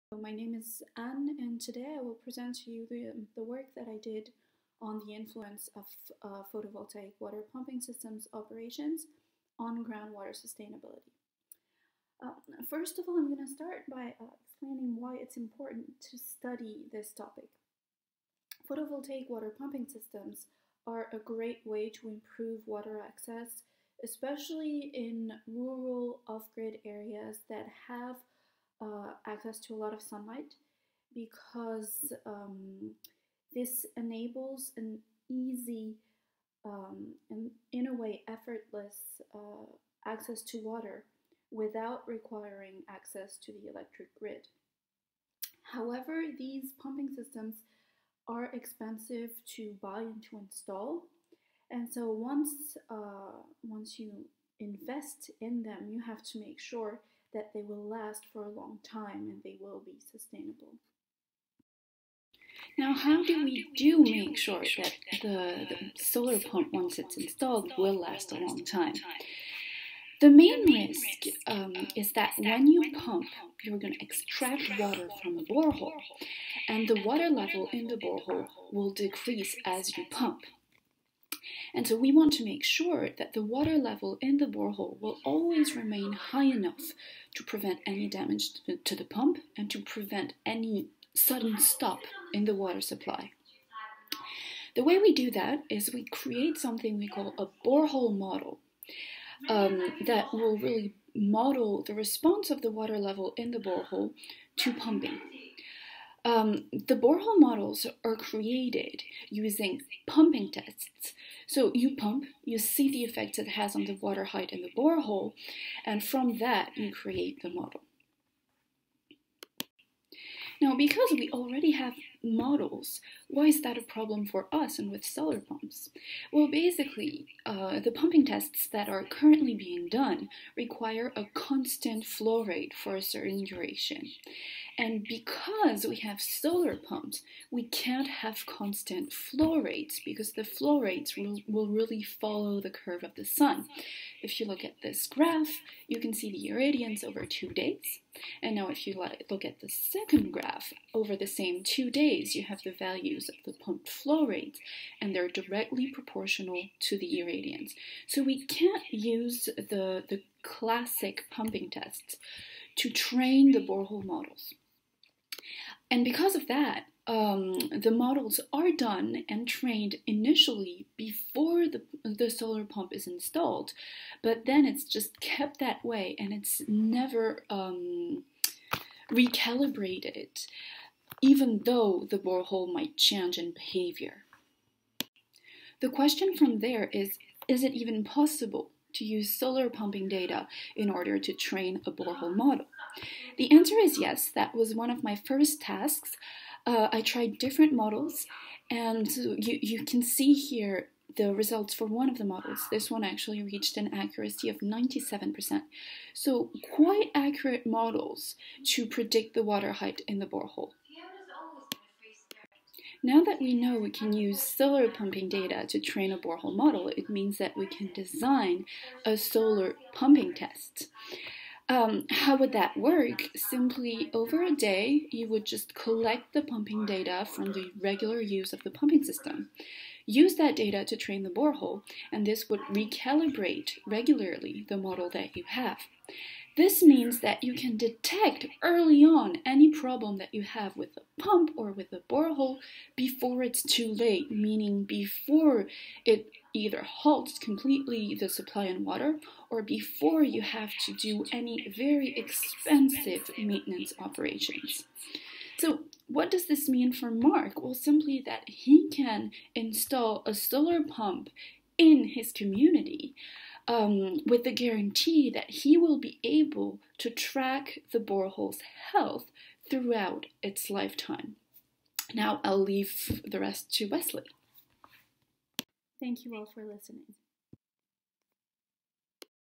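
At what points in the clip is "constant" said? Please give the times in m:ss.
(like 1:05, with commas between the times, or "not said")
2:11, 2:18.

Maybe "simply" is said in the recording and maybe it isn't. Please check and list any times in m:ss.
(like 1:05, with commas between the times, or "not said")
3:43, 4:17.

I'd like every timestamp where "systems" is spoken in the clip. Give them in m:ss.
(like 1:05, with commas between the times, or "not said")
0:07, 0:19, 0:47, 3:49.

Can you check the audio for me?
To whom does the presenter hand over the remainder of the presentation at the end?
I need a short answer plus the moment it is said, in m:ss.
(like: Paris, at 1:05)
Wesley, at 4:33.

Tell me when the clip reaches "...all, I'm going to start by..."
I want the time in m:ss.
0:13.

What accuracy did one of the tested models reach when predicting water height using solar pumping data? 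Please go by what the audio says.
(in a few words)
97%.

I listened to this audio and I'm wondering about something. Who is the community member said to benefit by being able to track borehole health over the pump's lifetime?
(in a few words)
Mark.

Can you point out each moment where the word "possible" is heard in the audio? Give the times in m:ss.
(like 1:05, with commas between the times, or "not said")
3:08.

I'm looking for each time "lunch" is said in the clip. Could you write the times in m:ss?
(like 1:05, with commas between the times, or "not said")
not said.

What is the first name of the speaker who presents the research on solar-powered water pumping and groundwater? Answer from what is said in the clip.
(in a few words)
Anne.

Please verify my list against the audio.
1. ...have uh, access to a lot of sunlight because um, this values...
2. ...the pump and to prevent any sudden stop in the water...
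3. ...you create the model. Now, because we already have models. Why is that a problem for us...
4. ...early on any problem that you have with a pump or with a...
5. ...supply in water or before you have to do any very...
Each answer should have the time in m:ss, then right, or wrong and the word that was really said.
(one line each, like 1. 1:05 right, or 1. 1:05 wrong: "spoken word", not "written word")
1. 0:27 wrong: "enables", not "values"
2. 1:28 right
3. 1:56 right
4. 3:58 right
5. 4:08 right.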